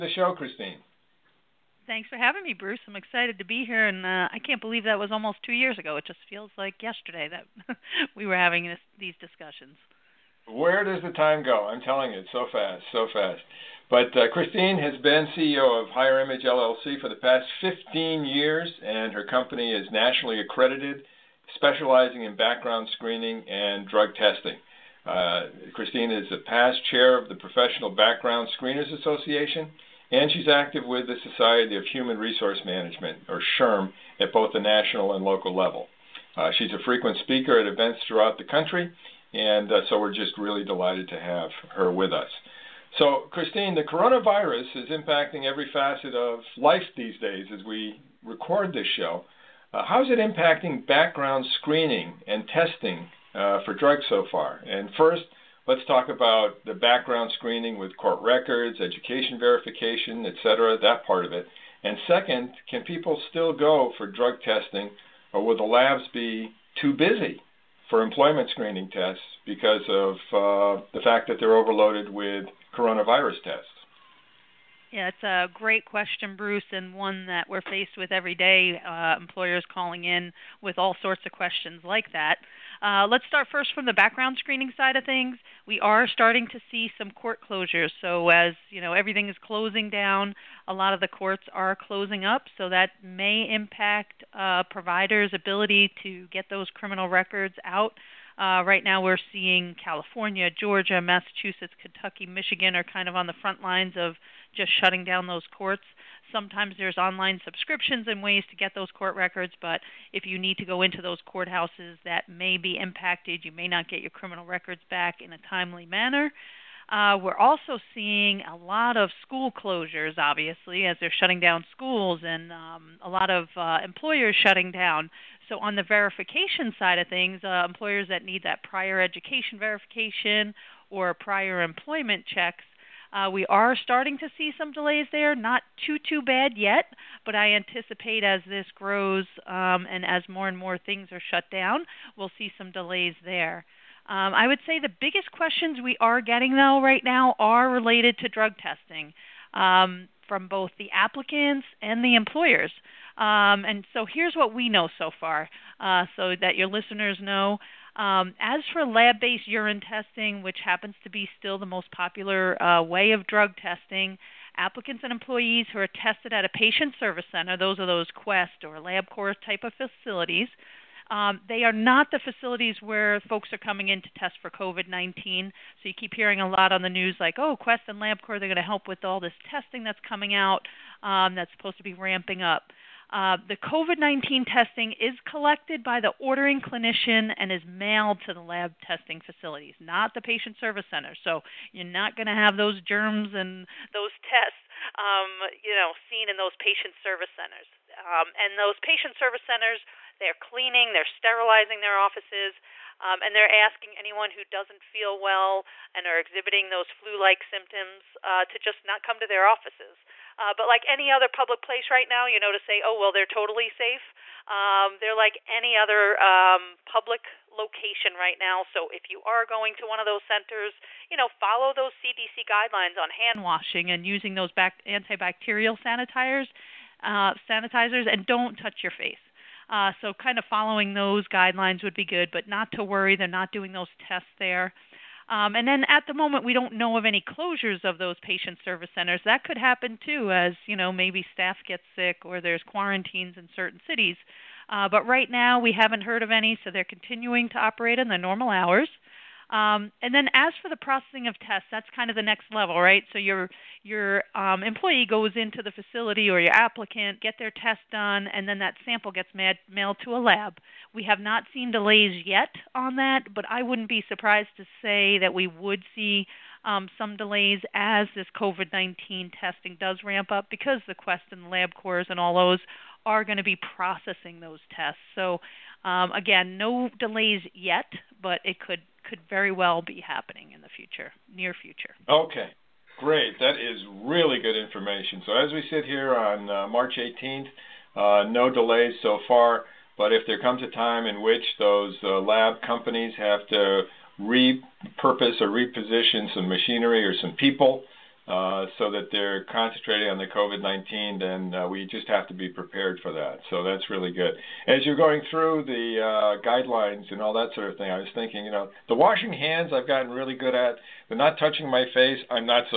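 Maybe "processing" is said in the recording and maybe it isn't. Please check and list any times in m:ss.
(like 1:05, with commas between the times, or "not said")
4:10, 4:33.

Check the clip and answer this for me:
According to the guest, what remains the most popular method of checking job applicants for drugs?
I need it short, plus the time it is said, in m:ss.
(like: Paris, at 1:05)
Lab based urine testing, at 2:38.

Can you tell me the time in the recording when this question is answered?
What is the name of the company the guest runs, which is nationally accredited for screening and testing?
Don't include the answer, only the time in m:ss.
0:15.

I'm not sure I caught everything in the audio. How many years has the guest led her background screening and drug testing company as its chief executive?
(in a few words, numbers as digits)
15.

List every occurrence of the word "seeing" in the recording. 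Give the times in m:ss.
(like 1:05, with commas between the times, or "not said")
1:39, 1:57.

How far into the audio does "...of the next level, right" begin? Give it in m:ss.
4:12.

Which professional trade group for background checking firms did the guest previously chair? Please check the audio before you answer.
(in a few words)
Professional Background Screeners Association.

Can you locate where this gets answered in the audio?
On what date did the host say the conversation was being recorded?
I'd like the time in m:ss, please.
4:46.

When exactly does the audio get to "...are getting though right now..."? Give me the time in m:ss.
2:26.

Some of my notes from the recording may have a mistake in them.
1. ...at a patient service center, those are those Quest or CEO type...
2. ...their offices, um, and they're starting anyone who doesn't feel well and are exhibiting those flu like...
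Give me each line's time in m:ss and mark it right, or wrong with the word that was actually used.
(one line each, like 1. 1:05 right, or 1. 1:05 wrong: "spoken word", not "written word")
1. 2:46 wrong: "LabCorp", not "CEO"
2. 3:21 wrong: "asking", not "starting".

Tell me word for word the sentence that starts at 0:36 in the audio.
Uh, she's a frequent speaker at events throughout the country and uh, so we're just really delighted to have her with us.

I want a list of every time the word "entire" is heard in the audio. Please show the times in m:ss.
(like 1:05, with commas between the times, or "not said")
not said.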